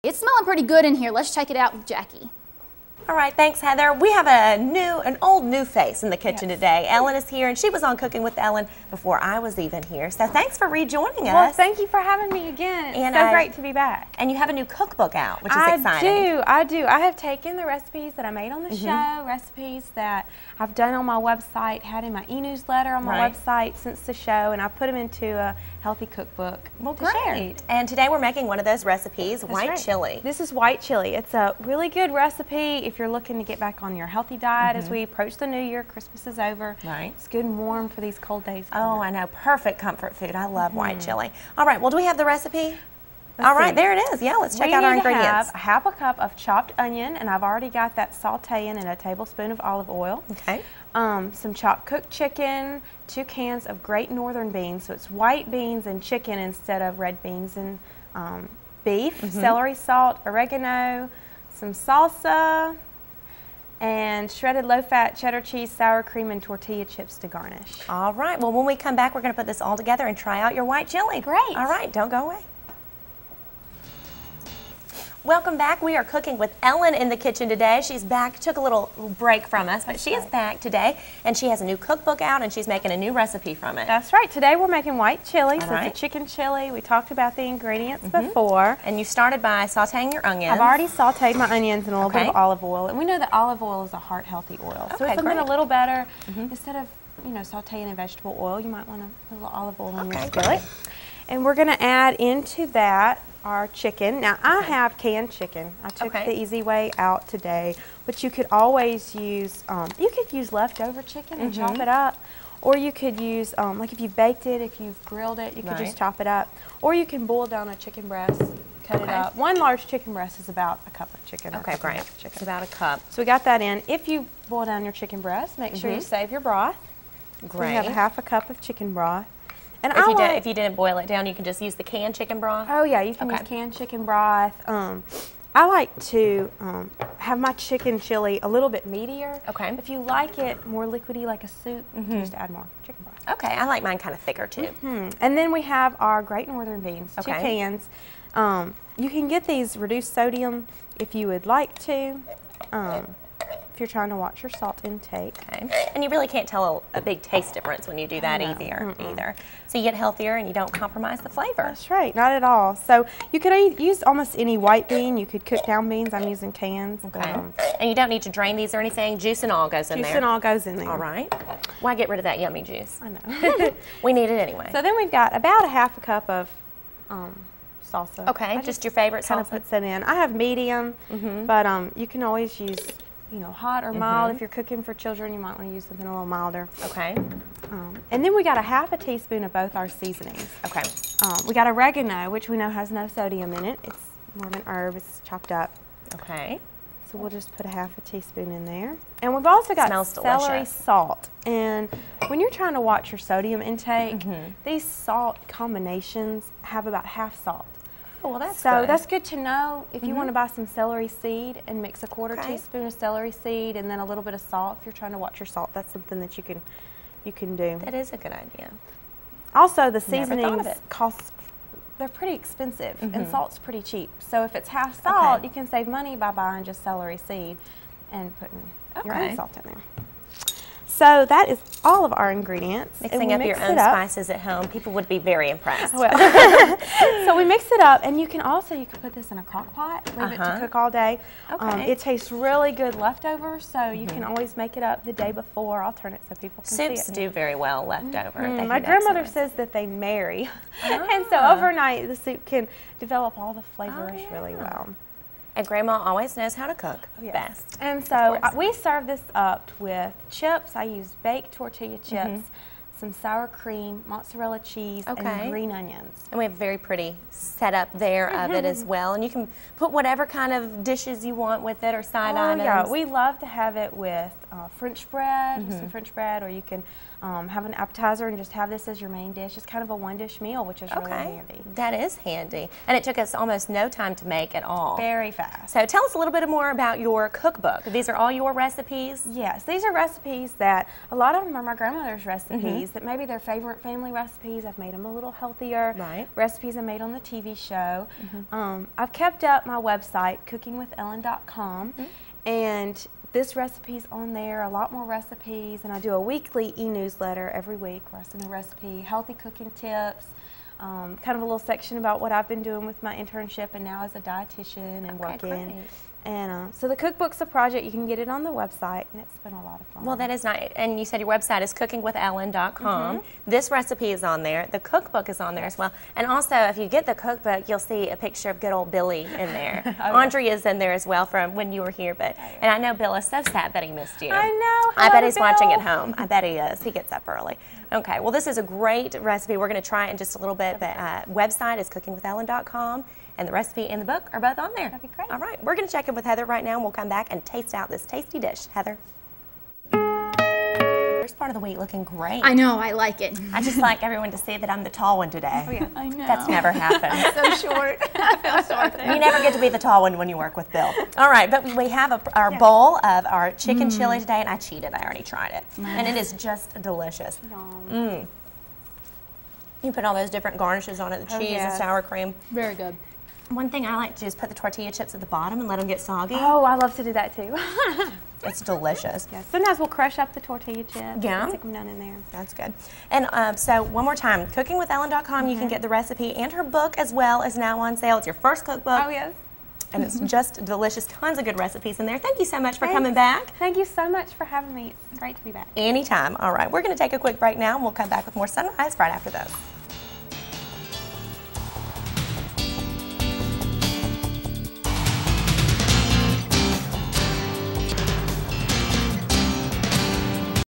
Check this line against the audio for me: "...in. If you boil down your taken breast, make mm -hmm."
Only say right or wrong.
wrong.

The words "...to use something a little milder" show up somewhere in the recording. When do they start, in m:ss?
3:05.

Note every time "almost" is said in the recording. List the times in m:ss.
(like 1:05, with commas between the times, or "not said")
2:44, 4:43.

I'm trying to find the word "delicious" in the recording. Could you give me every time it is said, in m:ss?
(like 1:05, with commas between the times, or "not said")
3:20, 6:06, 6:18, 6:30.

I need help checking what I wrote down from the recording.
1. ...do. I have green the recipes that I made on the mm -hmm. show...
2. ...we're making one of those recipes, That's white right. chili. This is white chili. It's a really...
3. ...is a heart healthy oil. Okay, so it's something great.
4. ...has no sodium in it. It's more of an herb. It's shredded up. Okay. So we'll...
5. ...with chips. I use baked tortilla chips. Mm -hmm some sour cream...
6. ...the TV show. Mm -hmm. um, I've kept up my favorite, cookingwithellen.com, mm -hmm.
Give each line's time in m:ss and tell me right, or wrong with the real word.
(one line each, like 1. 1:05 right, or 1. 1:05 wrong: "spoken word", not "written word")
1. 0:16 wrong: "taken", not "green"
2. 0:28 right
3. 1:33 right
4. 3:12 wrong: "chopped", not "shredded"
5. 4:19 right
6. 4:57 wrong: "website", not "favorite".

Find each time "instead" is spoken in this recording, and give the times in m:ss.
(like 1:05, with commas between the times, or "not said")
0:56, 1:36.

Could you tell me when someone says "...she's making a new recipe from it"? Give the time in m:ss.
1:22.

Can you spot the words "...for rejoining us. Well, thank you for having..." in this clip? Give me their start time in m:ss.
0:10.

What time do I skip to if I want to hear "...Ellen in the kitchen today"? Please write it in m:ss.
1:16.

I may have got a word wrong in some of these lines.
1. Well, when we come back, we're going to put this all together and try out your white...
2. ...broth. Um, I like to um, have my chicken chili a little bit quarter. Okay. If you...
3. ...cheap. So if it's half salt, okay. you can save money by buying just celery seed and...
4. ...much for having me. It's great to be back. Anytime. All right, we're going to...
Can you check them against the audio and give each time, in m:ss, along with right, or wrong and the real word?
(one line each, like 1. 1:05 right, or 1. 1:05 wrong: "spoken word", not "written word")
1. 1:08 right
2. 2:14 wrong: "meatier", not "quarter"
3. 3:43 right
4. 6:34 right.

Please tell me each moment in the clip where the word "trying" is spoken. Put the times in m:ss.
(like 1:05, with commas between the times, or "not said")
2:33, 3:22, 3:35.